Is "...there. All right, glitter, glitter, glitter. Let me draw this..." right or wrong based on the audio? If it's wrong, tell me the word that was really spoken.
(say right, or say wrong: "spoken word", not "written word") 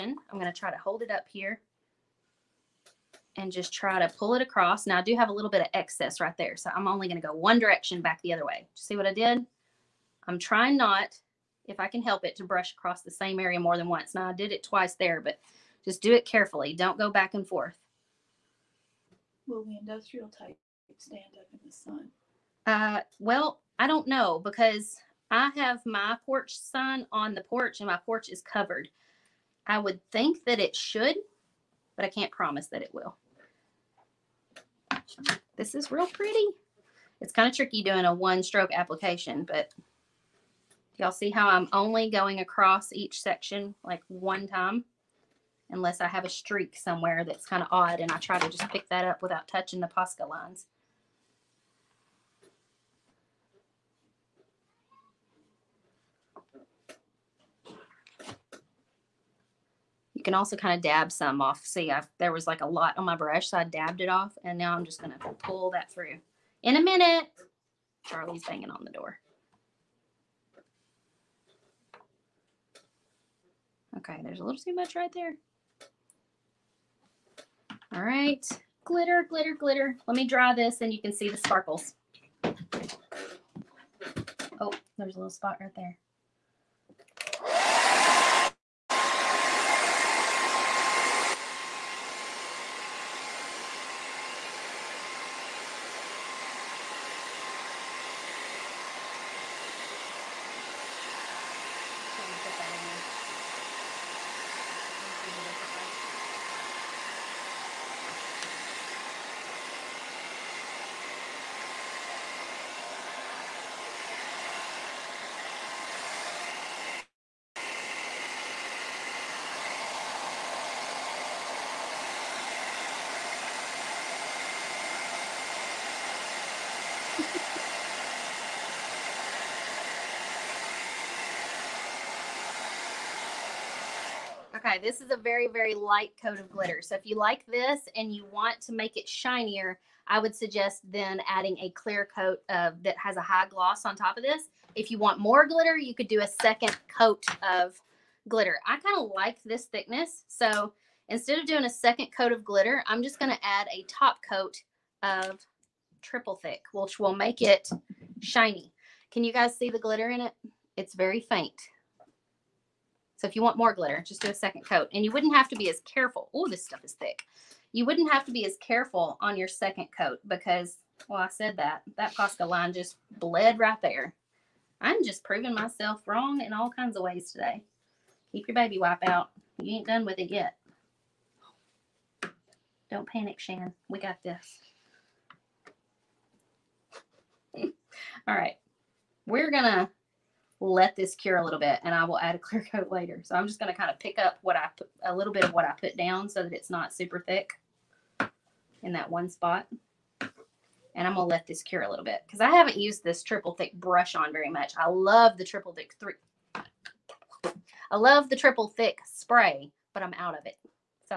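right.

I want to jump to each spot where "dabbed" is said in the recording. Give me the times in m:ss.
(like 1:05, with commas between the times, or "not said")
1:03.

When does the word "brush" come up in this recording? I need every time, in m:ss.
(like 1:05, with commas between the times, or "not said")
0:12, 1:03, 3:23.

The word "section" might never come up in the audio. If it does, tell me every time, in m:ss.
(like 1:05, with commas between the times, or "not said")
0:43.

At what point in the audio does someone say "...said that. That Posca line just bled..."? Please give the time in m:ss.
2:51.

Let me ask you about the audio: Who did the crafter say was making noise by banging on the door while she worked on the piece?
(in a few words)
Charlie.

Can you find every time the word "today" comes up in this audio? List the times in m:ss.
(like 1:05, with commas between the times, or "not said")
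2:57.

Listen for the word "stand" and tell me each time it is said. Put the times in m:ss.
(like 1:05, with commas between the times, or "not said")
0:20.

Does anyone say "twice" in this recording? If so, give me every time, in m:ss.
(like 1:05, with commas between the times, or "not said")
0:14.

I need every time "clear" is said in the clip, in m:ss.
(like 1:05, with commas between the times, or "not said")
2:21, 3:12.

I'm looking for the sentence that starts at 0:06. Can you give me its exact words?
So I'm only going to go one direction back the other way.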